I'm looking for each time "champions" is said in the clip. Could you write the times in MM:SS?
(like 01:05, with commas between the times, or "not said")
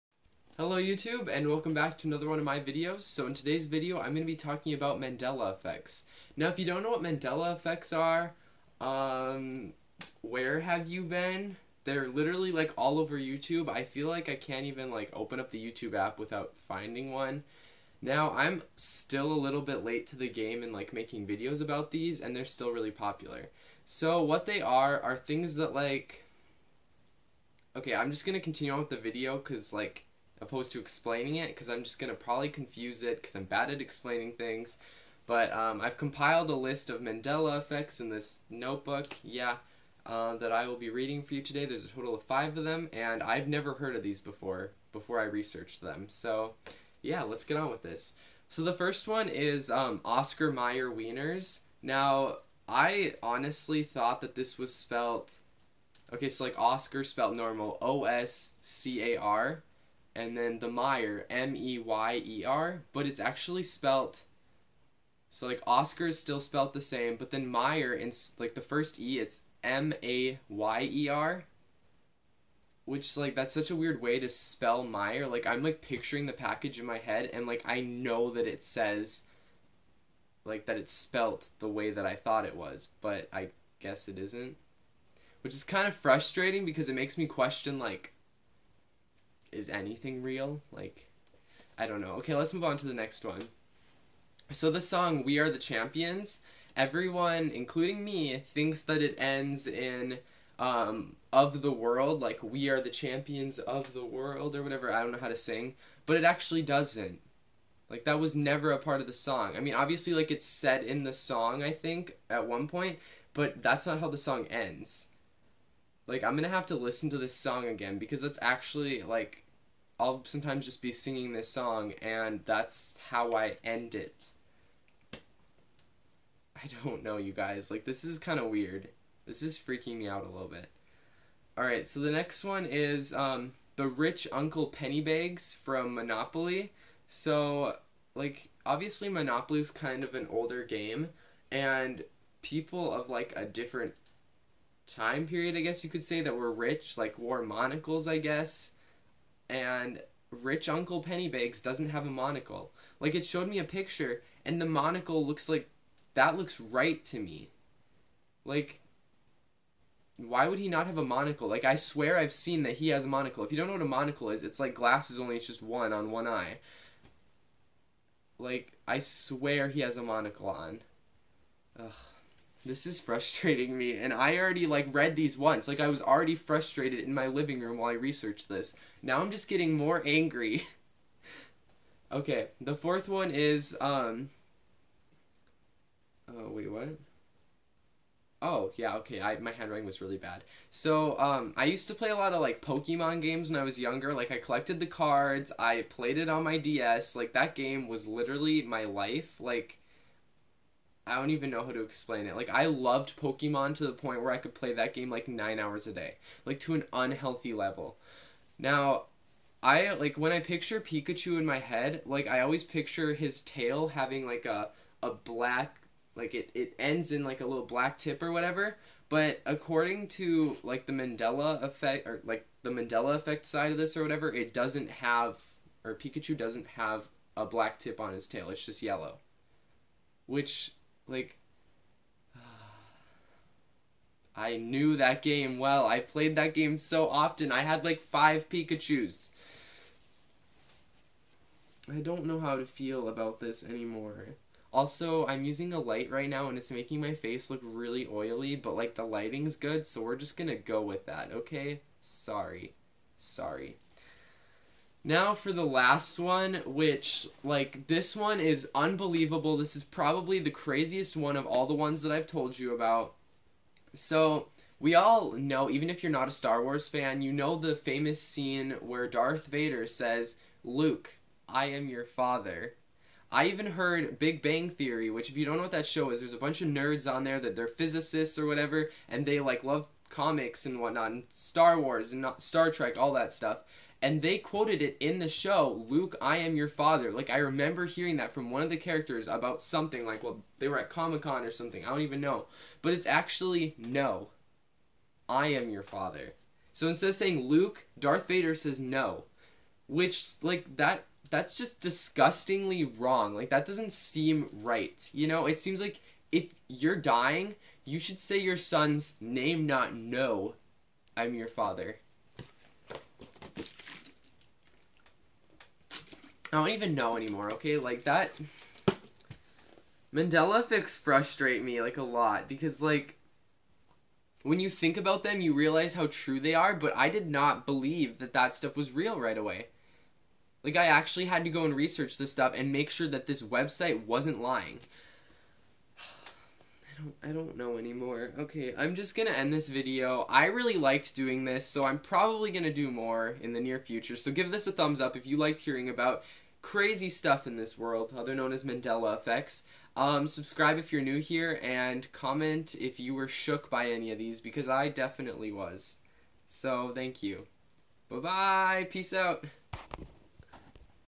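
01:35, 01:42.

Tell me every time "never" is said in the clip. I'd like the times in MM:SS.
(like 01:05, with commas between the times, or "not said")
00:43, 01:48.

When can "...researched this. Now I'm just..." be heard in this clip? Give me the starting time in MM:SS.
02:57.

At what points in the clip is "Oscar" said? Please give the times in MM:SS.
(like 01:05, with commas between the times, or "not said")
00:50, 00:56, 01:05.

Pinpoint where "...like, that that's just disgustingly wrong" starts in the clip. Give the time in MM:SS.
05:00.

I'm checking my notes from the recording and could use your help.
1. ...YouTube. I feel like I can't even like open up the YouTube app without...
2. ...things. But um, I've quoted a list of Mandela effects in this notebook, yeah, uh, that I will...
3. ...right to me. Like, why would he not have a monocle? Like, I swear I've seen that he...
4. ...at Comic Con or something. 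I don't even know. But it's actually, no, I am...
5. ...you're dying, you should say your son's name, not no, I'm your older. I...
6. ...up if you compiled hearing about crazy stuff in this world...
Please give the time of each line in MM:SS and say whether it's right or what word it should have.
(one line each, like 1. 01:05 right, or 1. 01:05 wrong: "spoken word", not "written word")
1. 00:13 right
2. 00:34 wrong: "compiled", not "quoted"
3. 02:36 right
4. 04:50 right
5. 05:06 wrong: "father", not "older"
6. 05:45 wrong: "liked", not "compiled".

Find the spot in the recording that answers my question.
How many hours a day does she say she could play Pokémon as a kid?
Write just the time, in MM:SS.
03:25.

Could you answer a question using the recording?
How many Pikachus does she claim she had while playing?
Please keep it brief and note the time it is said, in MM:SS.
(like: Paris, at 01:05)
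5, at 03:57.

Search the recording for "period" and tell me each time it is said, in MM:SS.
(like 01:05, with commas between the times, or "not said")
02:25.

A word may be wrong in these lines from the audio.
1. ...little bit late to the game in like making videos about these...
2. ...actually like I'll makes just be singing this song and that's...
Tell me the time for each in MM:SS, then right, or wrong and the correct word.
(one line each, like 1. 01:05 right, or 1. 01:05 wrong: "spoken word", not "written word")
1. 00:19 right
2. 01:58 wrong: "sometimes", not "makes".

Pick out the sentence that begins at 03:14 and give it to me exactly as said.
Like, I collected the cards, I played it on my DS.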